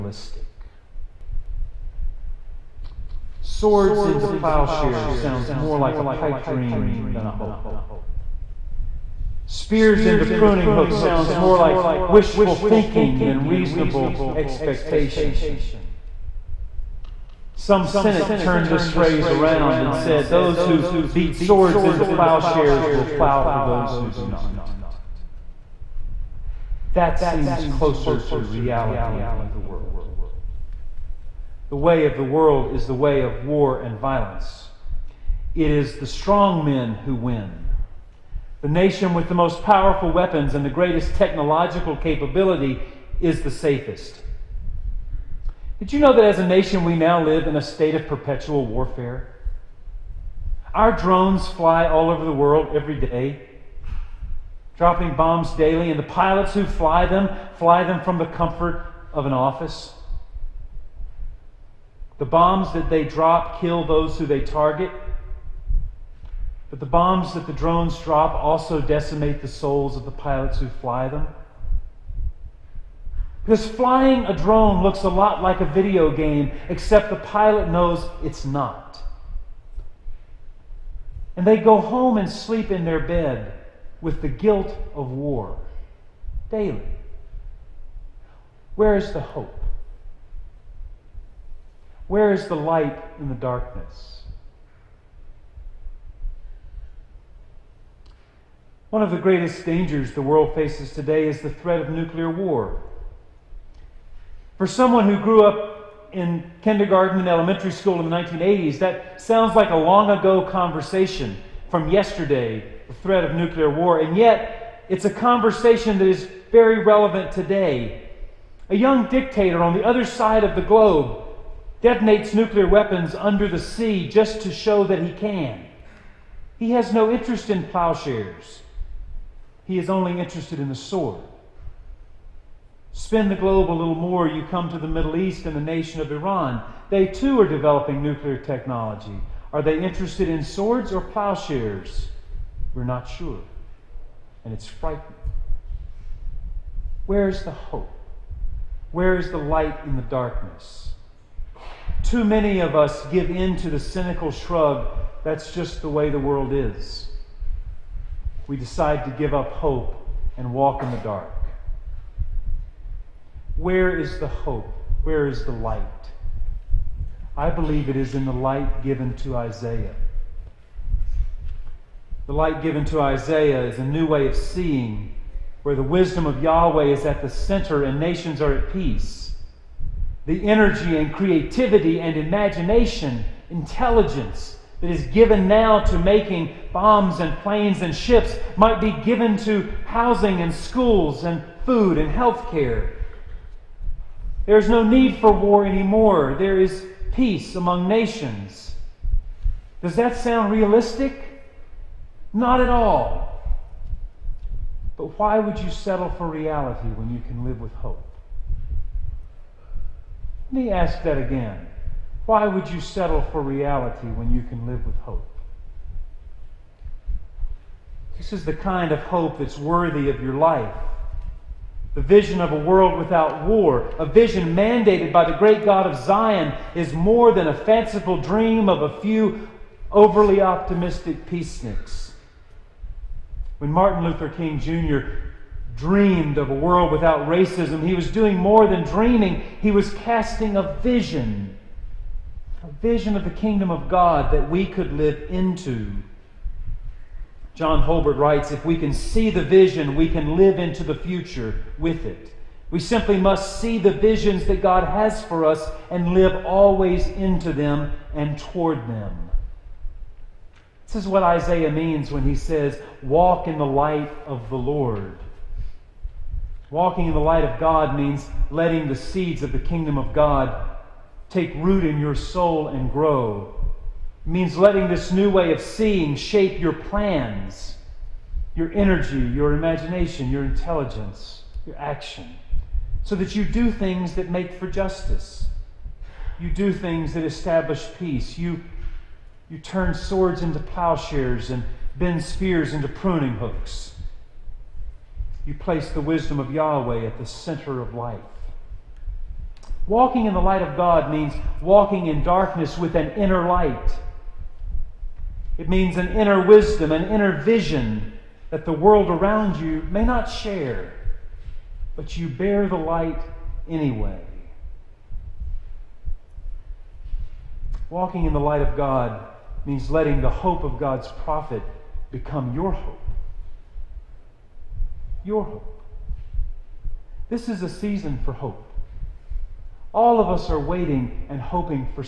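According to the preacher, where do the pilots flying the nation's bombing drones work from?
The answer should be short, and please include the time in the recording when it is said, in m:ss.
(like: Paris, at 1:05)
an office, at 0:58.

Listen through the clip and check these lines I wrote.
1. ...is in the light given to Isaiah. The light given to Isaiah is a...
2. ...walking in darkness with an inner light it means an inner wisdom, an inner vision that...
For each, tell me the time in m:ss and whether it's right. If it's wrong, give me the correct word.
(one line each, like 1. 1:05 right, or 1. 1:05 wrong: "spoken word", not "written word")
1. 2:47 right
2. 5:01 right.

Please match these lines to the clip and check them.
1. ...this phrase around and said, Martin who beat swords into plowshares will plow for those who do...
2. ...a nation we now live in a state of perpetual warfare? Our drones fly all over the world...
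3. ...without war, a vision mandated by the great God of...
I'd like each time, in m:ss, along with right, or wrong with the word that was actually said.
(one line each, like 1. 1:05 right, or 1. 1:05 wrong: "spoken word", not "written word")
1. 0:18 wrong: "Those", not "Martin"
2. 0:46 right
3. 3:42 right.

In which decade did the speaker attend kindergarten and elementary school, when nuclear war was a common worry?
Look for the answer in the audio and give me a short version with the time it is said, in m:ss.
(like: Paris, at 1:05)
1980s, at 1:48.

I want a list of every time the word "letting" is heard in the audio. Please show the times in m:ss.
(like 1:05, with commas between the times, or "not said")
4:28, 4:34, 5:19.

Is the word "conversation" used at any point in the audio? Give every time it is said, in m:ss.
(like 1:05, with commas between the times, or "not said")
1:50, 1:55.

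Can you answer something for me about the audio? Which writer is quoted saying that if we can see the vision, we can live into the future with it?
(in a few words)
John Holbert.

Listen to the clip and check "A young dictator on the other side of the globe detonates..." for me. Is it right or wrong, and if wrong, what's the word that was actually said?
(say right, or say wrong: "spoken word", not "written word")
right.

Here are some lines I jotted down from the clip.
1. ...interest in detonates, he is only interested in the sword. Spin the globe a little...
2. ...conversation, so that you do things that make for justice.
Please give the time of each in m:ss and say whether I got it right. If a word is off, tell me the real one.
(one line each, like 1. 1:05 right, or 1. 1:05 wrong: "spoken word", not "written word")
1. 2:07 wrong: "plowshares", not "detonates"
2. 4:41 wrong: "action", not "conversation".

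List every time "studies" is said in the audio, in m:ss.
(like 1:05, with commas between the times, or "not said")
not said.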